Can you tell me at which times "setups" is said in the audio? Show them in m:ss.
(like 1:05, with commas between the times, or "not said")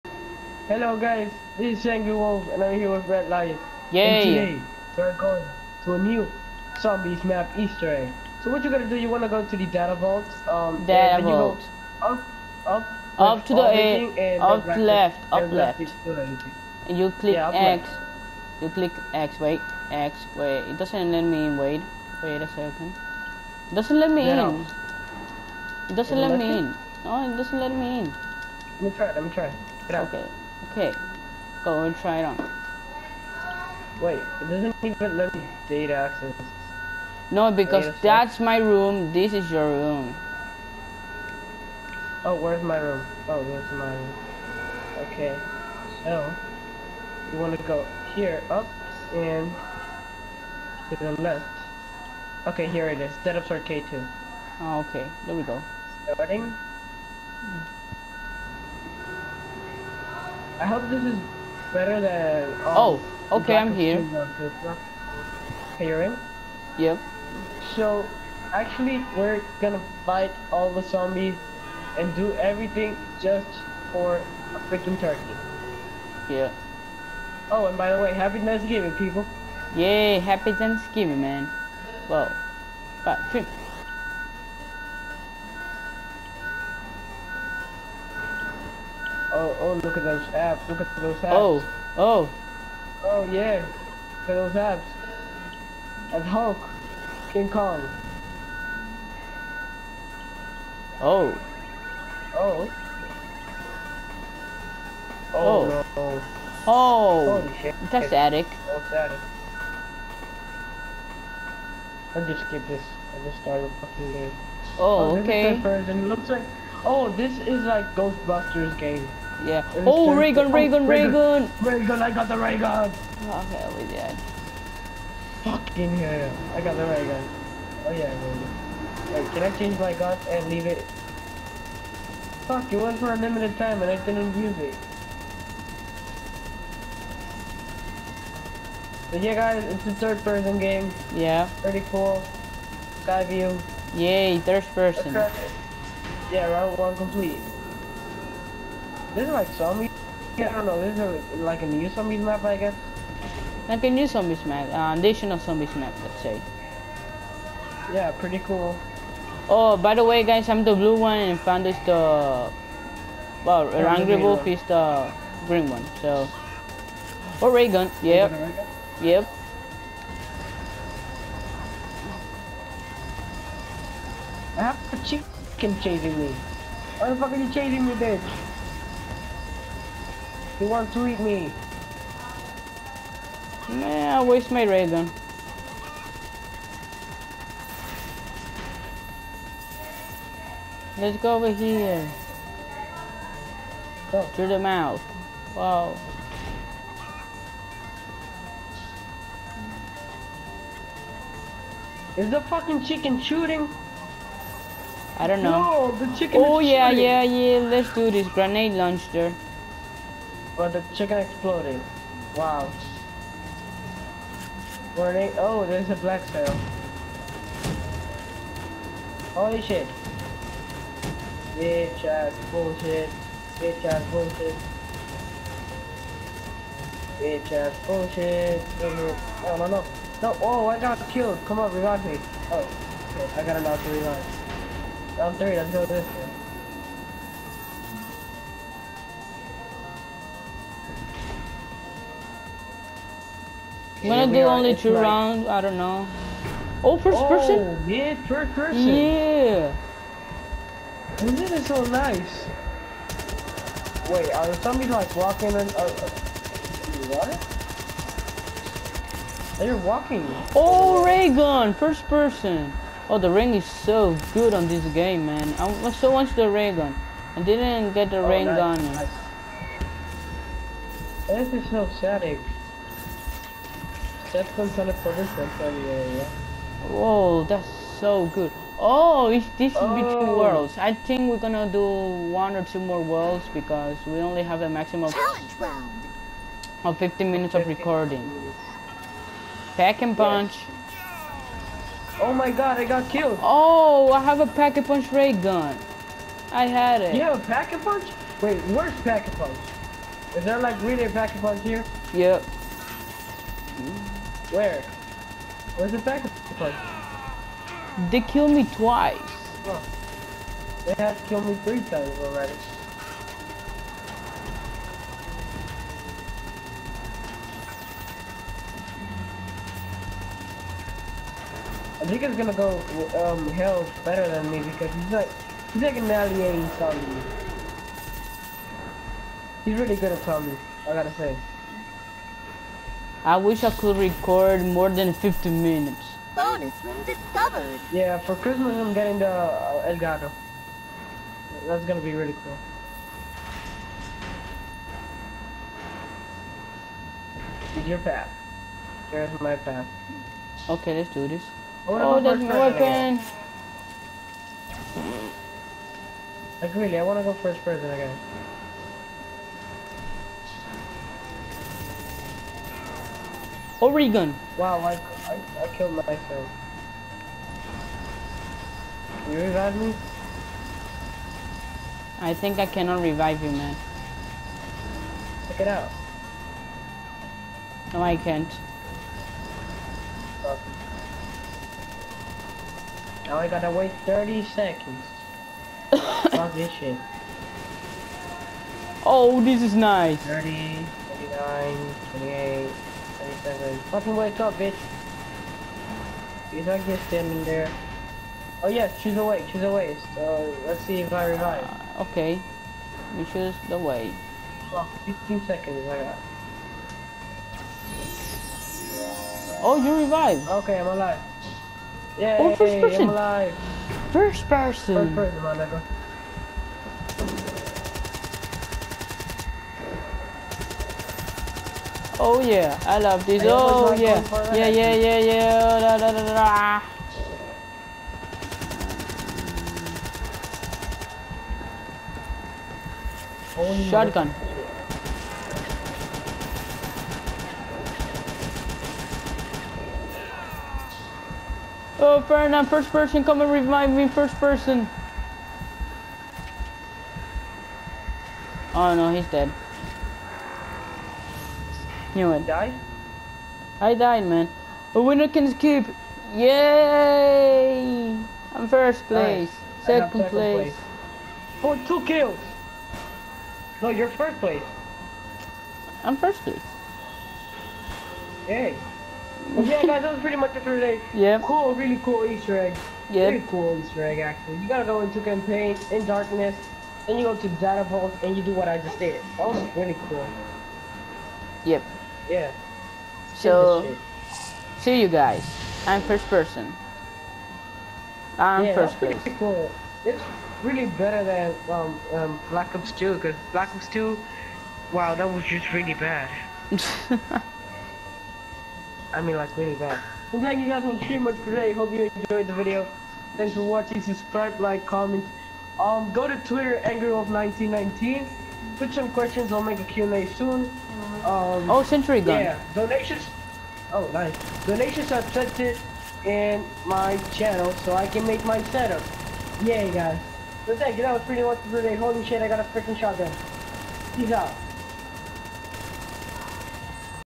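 0:53, 8:38.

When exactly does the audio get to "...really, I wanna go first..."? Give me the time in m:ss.
5:56.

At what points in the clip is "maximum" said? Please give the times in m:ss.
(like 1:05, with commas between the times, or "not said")
4:44.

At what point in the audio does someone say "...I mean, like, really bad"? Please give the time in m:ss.
8:19.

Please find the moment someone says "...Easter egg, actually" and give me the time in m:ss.
7:53.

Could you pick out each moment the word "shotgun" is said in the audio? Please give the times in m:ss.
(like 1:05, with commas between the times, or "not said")
7:13, 8:42.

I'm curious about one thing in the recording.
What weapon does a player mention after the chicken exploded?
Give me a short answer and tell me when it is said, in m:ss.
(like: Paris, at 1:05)
Grenade launcher, at 3:28.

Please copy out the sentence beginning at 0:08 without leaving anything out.
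So what you're gonna do, you wanna go to the data vault.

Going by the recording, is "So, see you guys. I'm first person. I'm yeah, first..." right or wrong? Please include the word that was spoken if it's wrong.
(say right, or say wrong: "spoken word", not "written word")
right.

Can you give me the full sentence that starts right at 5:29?
He's really good at zombies, I gotta say.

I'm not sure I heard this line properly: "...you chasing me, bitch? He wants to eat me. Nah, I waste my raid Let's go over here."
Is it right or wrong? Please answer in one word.
right.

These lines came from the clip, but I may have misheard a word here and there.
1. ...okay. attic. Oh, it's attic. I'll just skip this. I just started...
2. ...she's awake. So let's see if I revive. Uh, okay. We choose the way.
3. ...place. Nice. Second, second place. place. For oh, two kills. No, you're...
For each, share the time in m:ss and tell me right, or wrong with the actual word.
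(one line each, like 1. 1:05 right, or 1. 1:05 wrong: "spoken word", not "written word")
1. 1:48 right
2. 6:39 right
3. 7:39 right.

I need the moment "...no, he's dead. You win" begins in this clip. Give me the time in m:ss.
7:28.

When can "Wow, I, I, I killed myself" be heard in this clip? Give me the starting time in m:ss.
6:04.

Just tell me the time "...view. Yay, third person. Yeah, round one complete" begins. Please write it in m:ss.
2:23.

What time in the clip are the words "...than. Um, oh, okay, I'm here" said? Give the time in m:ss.
1:01.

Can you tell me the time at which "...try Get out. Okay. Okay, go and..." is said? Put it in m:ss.
0:29.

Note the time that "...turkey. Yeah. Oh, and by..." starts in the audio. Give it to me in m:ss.
1:14.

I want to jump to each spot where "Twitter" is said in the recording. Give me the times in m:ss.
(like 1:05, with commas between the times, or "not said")
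8:26.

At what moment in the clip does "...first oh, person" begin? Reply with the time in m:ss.
4:06.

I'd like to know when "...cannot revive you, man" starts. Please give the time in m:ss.
6:12.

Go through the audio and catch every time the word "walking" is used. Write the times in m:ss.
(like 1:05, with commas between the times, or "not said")
4:15, 4:19.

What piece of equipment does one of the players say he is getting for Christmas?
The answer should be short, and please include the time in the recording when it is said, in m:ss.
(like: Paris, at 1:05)
Elgato, at 5:39.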